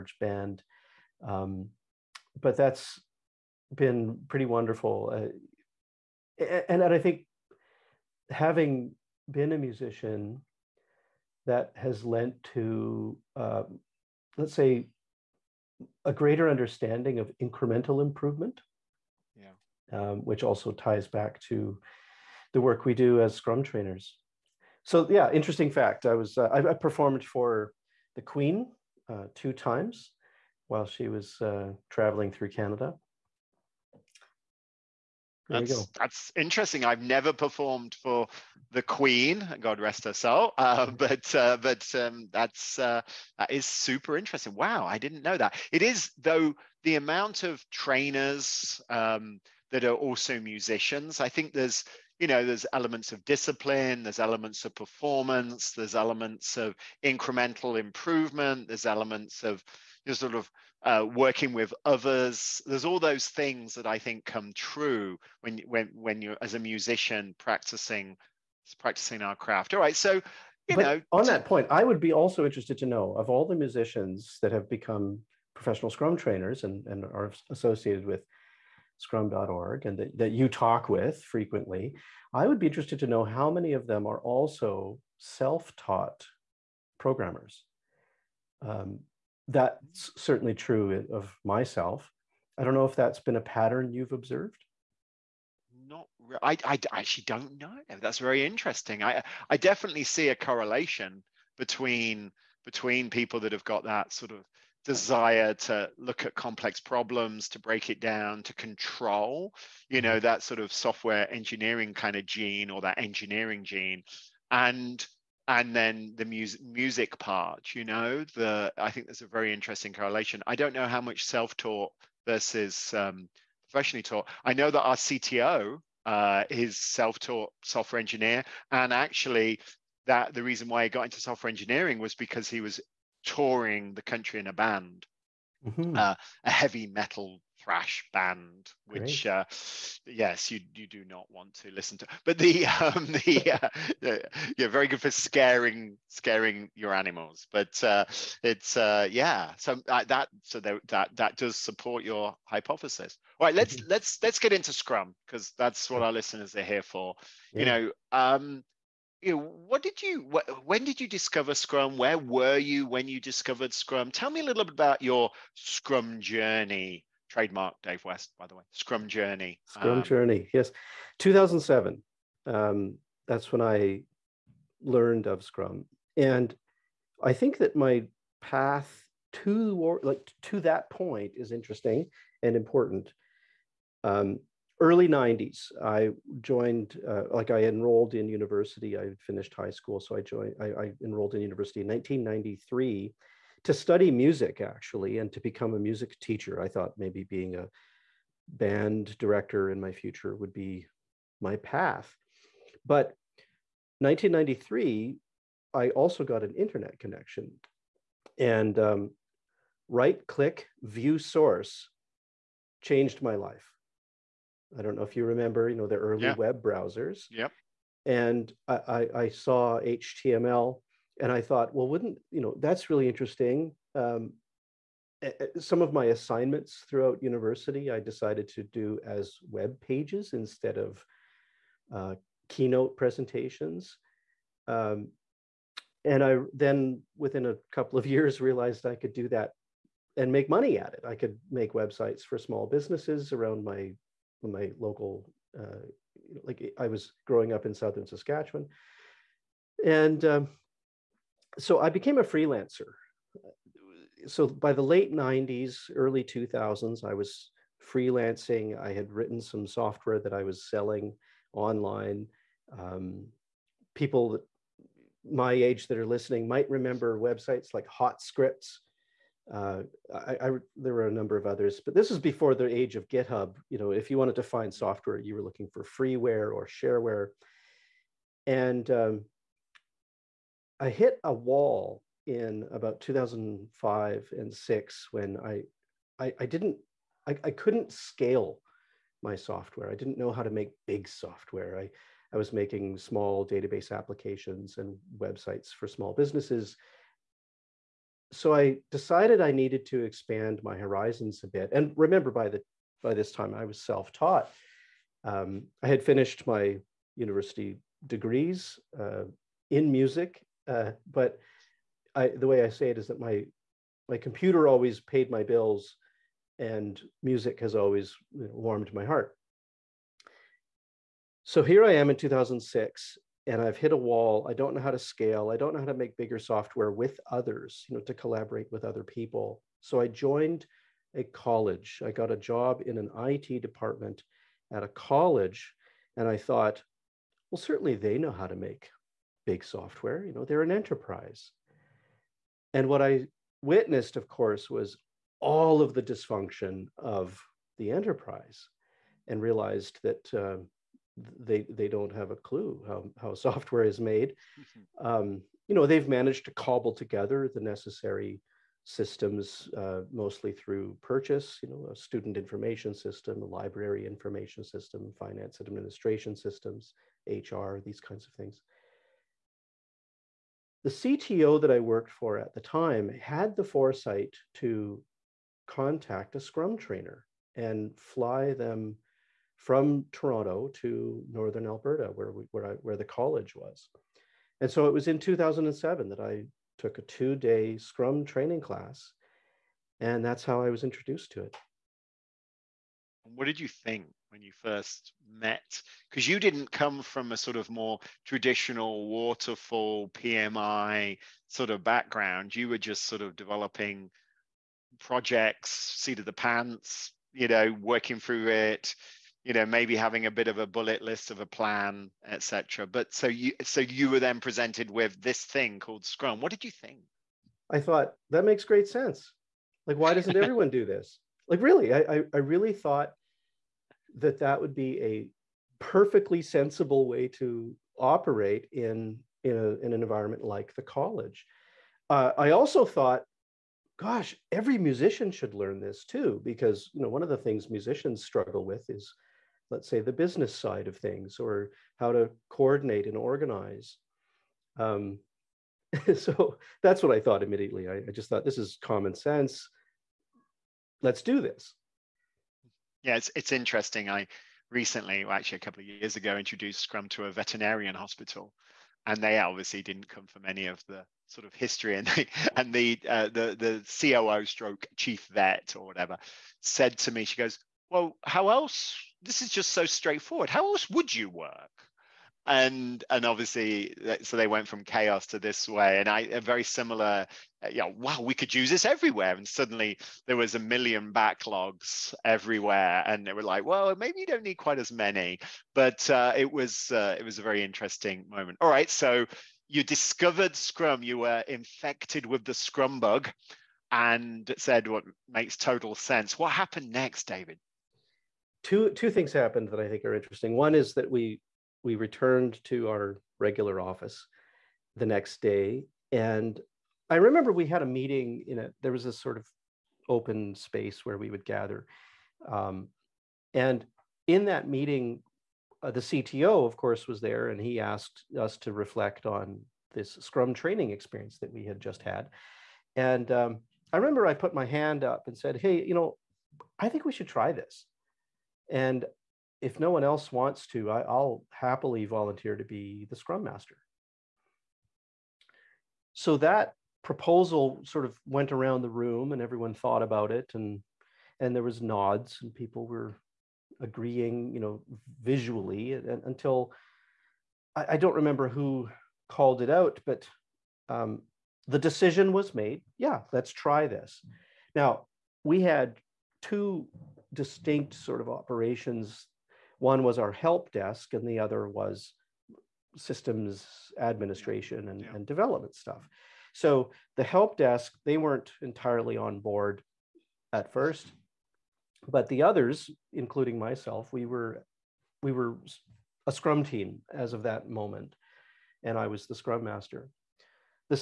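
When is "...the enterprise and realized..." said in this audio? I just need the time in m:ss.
5:47.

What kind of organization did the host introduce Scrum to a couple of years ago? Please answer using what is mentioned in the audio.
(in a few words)
veterinarian hospital.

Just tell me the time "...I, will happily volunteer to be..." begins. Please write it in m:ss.
8:50.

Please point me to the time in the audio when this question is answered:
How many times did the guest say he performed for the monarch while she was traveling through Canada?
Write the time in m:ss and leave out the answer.
0:29.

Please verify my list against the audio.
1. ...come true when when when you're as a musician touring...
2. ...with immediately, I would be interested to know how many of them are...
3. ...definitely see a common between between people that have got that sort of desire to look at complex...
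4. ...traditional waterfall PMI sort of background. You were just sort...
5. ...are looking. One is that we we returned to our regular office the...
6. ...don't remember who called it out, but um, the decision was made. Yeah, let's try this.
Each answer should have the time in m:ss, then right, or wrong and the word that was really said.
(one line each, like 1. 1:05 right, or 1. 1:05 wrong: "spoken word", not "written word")
1. 1:04 wrong: "practicing", not "touring"
2. 1:20 wrong: "frequently", not "immediately"
3. 1:39 wrong: "correlation", not "common"
4. 6:38 right
5. 8:20 wrong: "interesting", not "looking"
6. 9:07 right.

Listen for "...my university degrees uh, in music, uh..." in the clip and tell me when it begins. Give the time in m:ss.
5:06.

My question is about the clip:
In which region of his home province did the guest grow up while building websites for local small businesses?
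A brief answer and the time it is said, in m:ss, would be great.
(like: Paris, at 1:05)
Southern Saskatchewan, at 4:07.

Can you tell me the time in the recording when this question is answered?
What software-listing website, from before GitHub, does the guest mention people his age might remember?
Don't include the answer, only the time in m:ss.
4:27.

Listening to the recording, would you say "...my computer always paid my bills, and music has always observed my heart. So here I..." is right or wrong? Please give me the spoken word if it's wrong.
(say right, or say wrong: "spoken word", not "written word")
wrong: "warmed", not "observed".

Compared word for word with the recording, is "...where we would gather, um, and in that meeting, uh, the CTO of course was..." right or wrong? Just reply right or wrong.
right.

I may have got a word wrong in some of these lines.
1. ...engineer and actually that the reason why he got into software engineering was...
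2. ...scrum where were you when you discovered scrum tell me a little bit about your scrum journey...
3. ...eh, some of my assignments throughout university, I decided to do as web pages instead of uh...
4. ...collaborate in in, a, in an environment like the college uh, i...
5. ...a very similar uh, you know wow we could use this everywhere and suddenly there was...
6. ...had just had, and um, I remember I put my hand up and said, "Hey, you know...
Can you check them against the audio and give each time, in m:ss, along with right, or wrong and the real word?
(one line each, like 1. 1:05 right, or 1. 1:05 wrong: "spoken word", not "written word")
1. 2:07 right
2. 2:41 right
3. 3:45 right
4. 7:07 wrong: "operate", not "collaborate"
5. 7:56 right
6. 8:41 right.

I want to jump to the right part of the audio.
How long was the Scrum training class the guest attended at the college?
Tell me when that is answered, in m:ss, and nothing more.
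6:27.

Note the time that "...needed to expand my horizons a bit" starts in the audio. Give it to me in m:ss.
4:59.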